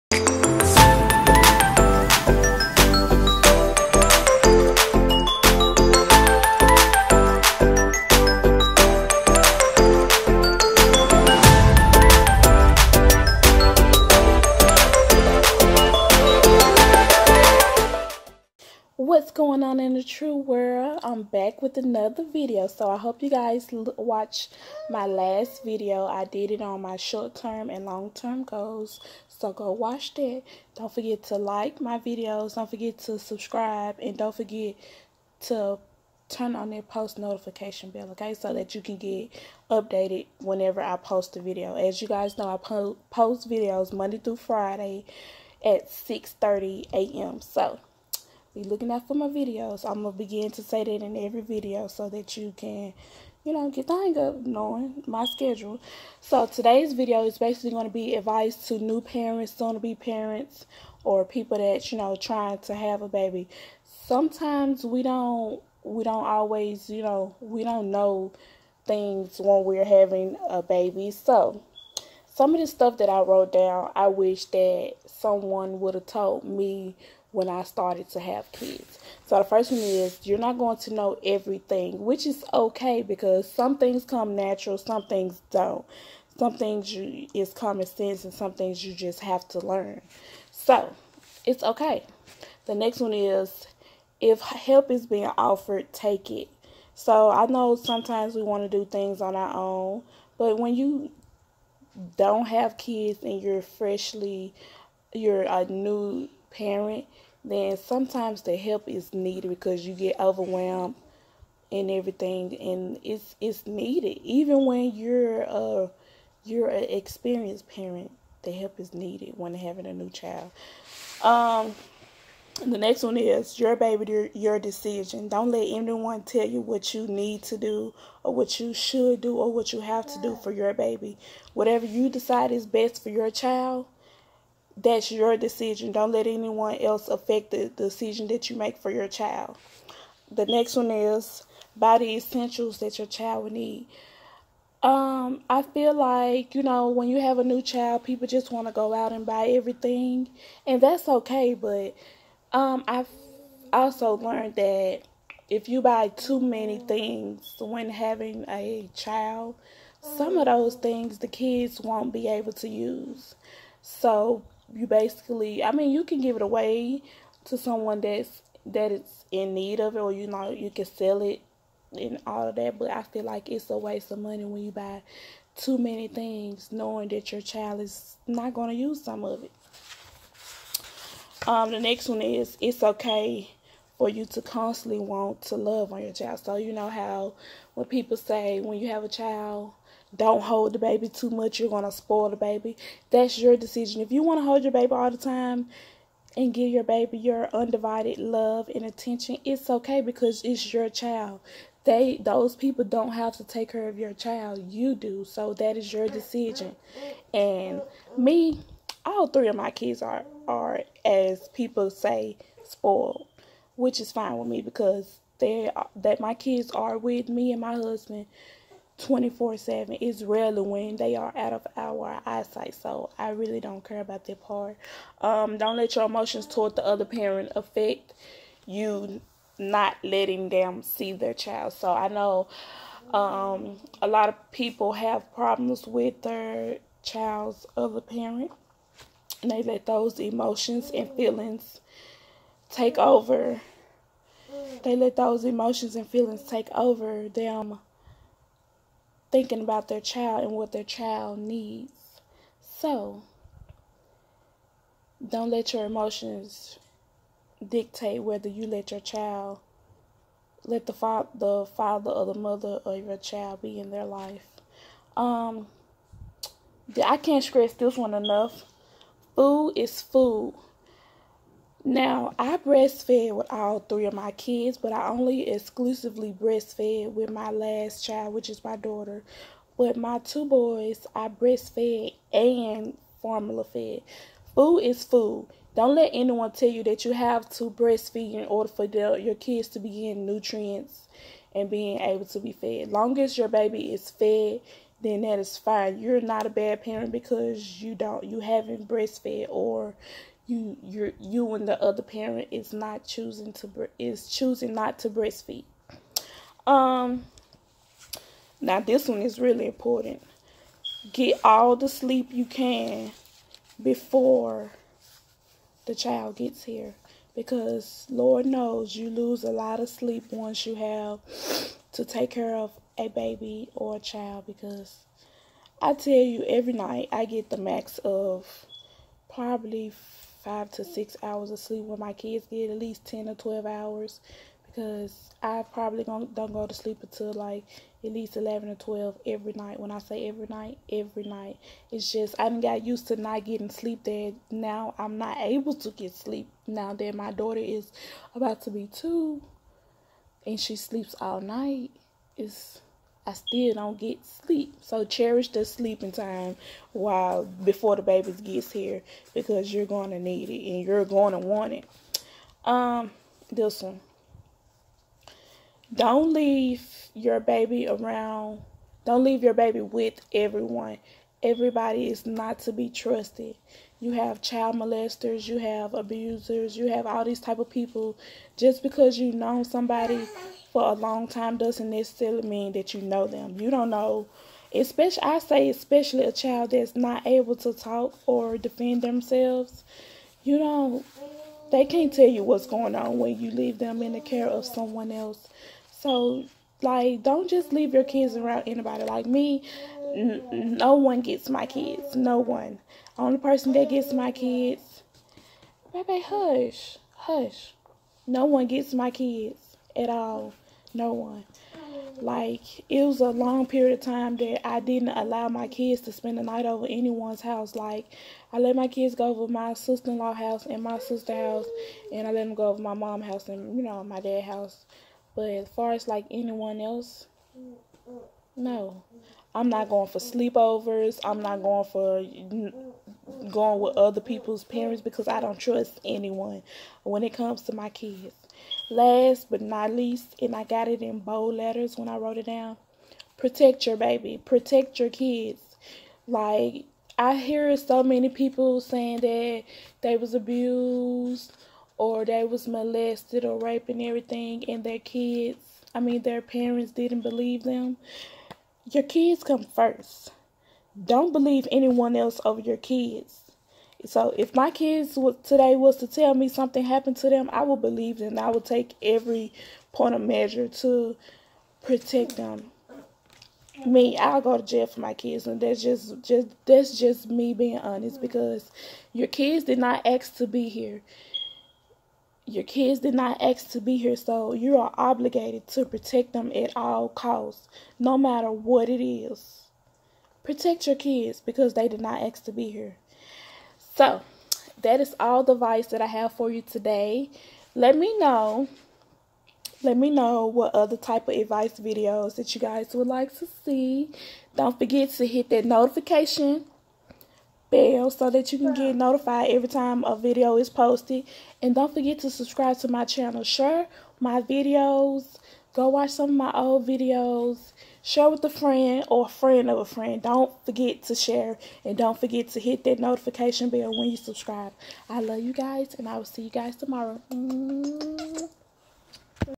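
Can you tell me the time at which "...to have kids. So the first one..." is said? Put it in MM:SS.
01:18.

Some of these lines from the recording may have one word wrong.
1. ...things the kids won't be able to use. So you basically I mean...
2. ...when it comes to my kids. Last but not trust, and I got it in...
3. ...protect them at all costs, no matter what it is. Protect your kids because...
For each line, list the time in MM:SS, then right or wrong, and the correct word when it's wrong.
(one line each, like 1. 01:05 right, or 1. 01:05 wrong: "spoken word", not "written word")
1. 02:40 right
2. 07:17 wrong: "least", not "trust"
3. 08:05 right.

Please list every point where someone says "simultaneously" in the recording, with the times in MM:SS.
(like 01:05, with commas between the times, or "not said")
not said.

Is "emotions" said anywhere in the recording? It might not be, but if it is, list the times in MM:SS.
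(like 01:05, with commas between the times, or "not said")
03:46, 04:00, 04:05, 04:15.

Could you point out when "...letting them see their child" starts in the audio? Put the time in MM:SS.
03:50.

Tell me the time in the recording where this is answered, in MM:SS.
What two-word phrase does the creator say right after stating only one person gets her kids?
06:46.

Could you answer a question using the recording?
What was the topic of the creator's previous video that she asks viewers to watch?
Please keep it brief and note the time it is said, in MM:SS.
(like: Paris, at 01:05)
Short-term and long-term goals, at 00:26.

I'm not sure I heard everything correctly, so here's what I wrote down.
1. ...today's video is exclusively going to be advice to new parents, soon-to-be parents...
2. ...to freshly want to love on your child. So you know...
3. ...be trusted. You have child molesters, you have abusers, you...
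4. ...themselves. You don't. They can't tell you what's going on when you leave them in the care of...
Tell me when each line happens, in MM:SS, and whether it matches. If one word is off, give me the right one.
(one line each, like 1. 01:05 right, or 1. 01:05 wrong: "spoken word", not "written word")
1. 00:56 wrong: "basically", not "exclusively"
2. 03:04 wrong: "constantly", not "freshly"
3. 06:12 right
4. 06:29 right.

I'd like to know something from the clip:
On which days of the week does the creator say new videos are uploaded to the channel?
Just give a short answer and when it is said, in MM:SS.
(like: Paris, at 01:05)
Monday through Friday, at 00:43.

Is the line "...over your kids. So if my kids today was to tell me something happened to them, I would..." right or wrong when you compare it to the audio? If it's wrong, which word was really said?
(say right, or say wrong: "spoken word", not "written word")
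right.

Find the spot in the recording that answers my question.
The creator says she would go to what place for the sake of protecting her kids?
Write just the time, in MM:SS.
07:54.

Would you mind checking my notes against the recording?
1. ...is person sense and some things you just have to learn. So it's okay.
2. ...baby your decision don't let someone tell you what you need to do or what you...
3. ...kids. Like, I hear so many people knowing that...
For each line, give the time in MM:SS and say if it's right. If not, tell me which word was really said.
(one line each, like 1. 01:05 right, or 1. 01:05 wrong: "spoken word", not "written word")
1. 01:27 wrong: "common", not "person"
2. 02:03 wrong: "anyone", not "someone"
3. 07:25 wrong: "saying", not "knowing".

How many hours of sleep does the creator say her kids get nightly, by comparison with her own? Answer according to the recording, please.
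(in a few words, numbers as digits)
10 or 12 hours.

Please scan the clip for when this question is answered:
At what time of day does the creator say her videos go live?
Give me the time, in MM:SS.
00:45.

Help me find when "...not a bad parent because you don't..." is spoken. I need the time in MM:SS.
04:56.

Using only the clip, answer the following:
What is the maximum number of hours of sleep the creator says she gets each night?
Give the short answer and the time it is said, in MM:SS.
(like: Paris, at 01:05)
5 to 6 hours, at 05:30.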